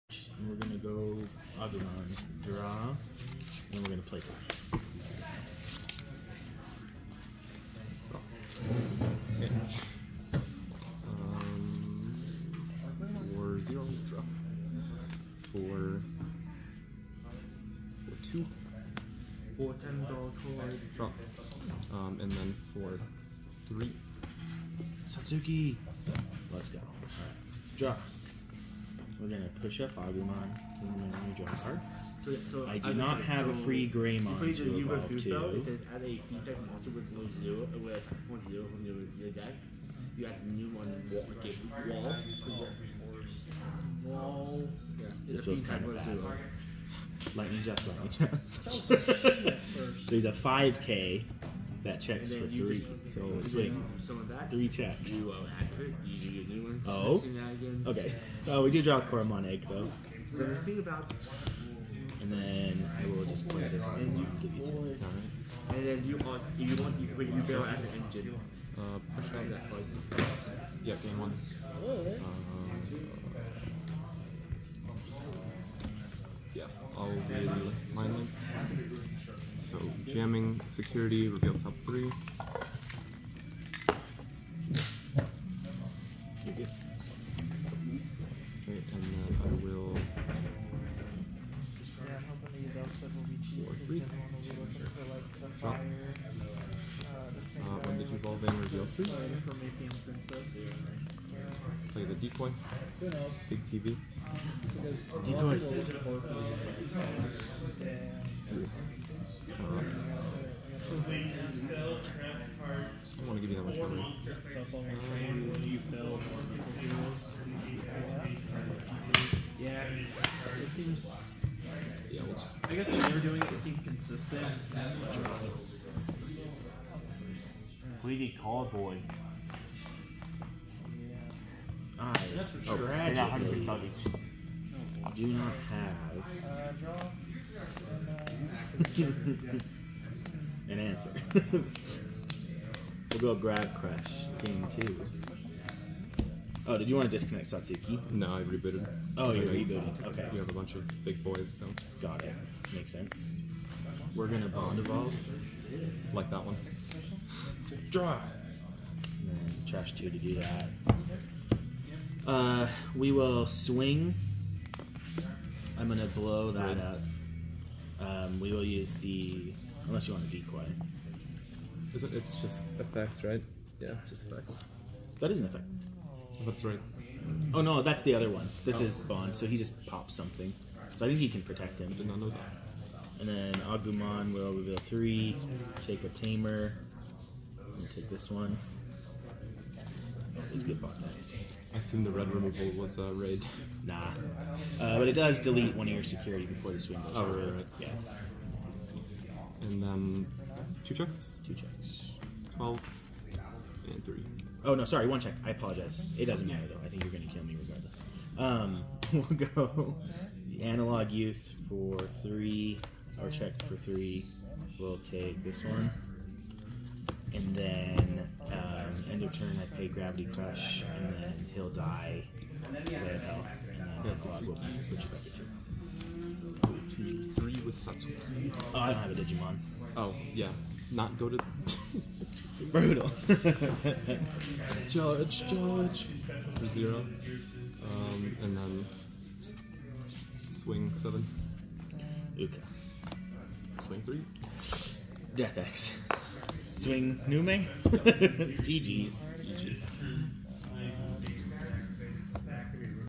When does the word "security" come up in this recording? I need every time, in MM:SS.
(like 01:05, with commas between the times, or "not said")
01:20, 03:16.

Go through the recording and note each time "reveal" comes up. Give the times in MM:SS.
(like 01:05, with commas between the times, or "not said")
01:21, 01:38, 03:04.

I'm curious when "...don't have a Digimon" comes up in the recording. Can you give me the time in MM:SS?
03:48.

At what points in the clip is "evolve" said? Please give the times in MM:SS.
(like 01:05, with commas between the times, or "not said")
00:34, 01:38, 02:34.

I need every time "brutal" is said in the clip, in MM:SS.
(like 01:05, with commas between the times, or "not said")
03:52.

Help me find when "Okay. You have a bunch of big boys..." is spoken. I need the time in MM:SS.
02:30.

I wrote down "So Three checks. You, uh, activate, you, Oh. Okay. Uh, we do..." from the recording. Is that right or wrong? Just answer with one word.
right.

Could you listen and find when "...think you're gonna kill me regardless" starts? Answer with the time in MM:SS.
03:26.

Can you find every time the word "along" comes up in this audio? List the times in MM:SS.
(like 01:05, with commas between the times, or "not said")
not said.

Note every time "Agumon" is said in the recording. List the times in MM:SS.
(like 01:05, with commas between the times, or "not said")
00:29, 03:03.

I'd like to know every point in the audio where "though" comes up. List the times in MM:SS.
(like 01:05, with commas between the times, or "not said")
00:59, 03:26.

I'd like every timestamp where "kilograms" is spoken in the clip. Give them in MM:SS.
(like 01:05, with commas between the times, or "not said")
not said.